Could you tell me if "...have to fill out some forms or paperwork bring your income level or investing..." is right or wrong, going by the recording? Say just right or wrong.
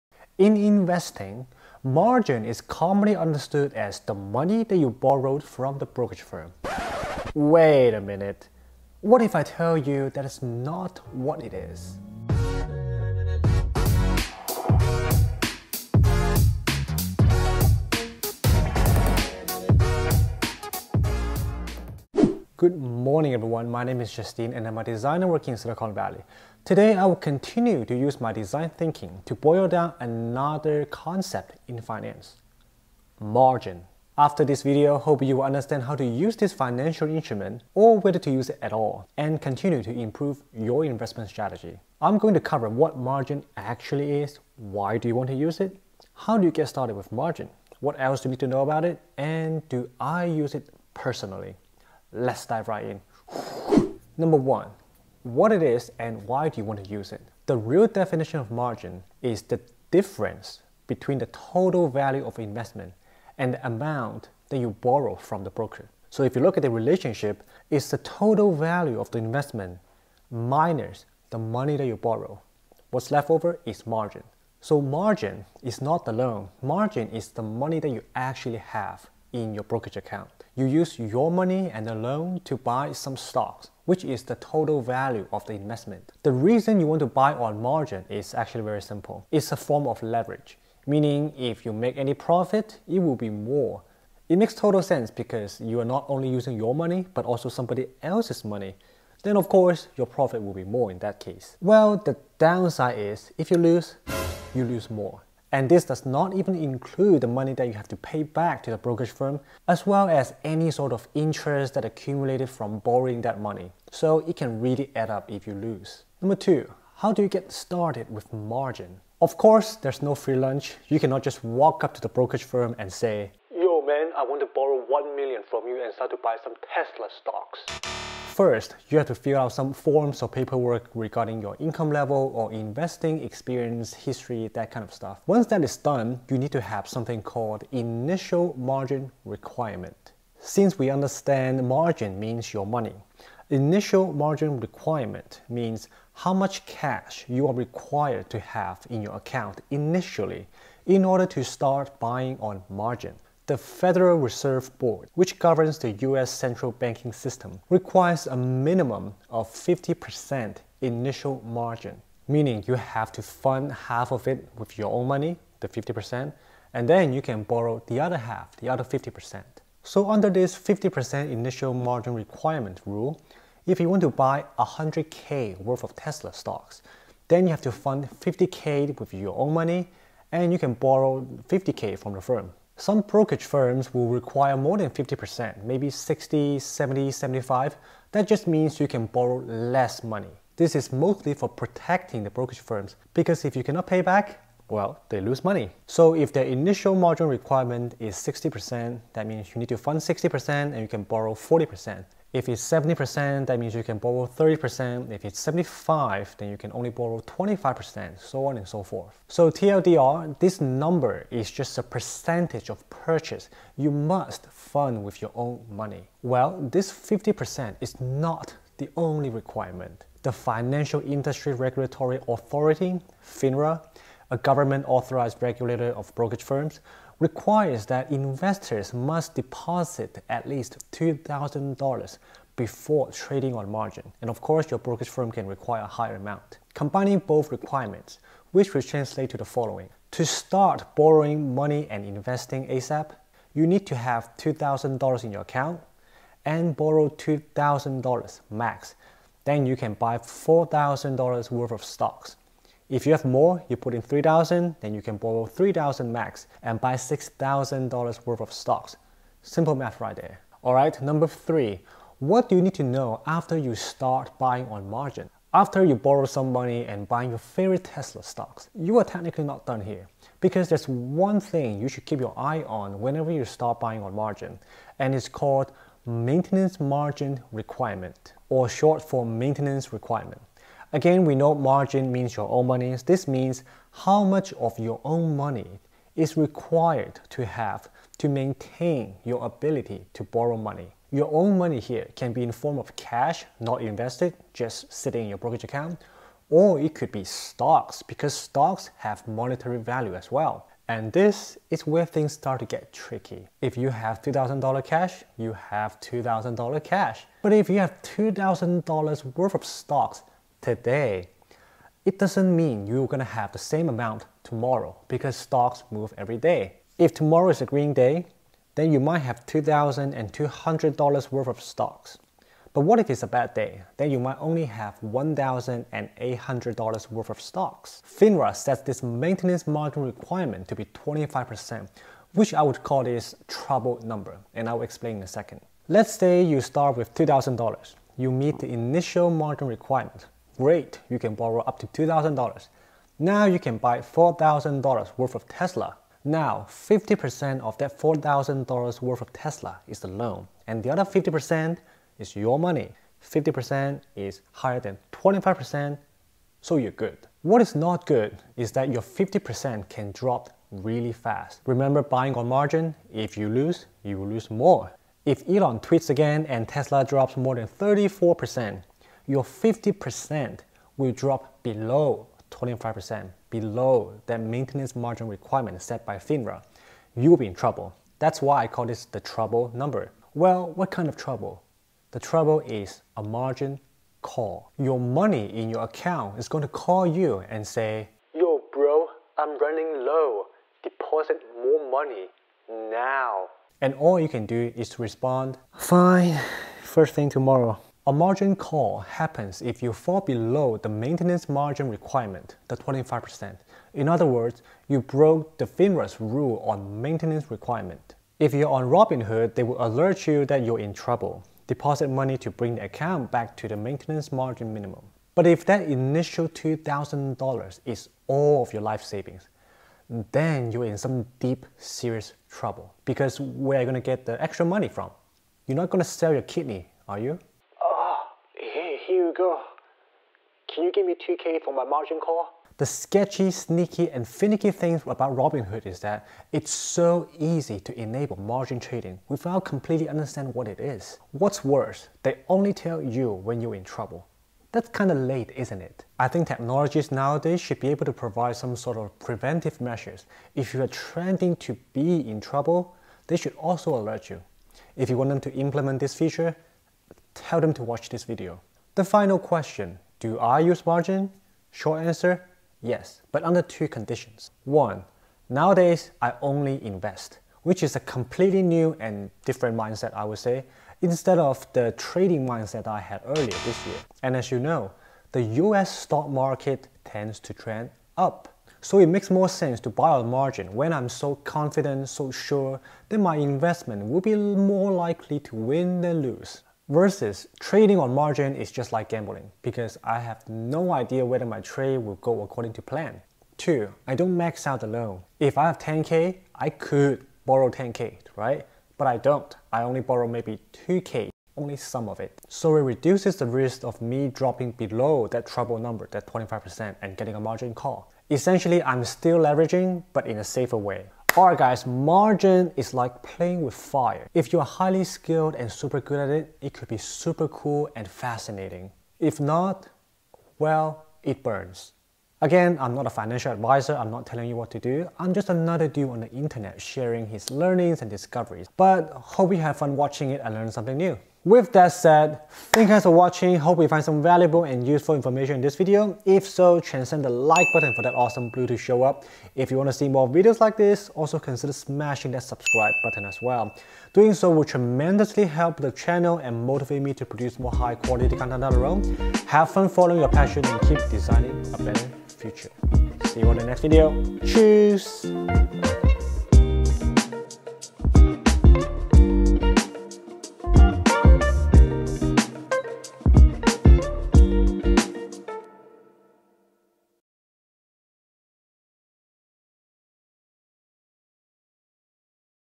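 wrong.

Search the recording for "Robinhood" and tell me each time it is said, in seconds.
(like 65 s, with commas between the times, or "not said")
408 s, 435 s.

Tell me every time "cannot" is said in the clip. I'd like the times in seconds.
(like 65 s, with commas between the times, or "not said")
121 s, 193 s.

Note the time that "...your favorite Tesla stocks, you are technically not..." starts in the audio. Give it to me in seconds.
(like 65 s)
267 s.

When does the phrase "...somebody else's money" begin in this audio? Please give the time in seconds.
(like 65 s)
97 s.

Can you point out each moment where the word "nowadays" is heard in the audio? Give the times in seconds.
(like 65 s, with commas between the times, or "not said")
447 s, 465 s.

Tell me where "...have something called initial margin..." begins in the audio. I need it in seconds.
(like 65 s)
136 s.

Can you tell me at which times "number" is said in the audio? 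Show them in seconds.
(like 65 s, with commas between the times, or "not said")
54 s, 116 s, 210 s, 261 s, 334 s, 379 s, 505 s.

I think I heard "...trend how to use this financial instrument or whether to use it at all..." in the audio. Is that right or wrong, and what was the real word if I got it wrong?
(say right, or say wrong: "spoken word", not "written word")
wrong: "understand", not "trend".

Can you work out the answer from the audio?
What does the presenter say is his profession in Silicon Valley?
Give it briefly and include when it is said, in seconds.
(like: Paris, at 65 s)
Designer, at 24 s.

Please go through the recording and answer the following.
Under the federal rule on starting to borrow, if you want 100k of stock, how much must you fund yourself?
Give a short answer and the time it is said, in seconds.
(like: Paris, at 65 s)
50k, at 177 s.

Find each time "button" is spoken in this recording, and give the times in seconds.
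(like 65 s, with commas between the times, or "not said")
537 s, 543 s.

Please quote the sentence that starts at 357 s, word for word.
What is not good is that your 50% can drop really fast.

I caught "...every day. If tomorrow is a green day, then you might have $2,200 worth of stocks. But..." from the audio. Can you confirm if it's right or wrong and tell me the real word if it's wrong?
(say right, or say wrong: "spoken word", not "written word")
right.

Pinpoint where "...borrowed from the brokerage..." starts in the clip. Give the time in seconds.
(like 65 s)
4 s.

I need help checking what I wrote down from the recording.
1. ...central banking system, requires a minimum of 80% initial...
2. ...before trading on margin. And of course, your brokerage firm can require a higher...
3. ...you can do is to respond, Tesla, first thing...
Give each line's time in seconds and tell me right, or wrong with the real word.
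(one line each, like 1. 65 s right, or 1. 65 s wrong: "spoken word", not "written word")
1. 156 s wrong: "50", not "80"
2. 232 s right
3. 394 s wrong: "Fine", not "Tesla".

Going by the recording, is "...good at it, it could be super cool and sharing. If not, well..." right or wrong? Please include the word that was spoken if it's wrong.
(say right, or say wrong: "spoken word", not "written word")
wrong: "fascinating", not "sharing".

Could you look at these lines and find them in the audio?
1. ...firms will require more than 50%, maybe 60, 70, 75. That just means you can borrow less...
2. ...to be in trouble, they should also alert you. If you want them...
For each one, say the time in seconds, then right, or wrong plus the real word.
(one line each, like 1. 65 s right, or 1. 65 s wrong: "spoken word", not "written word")
1. 183 s right
2. 451 s right.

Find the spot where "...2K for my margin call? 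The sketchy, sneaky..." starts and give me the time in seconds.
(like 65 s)
431 s.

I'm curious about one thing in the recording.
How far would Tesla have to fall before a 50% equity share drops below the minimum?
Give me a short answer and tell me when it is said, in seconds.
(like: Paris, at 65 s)
34%, at 367 s.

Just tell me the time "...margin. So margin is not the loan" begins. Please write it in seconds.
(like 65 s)
73 s.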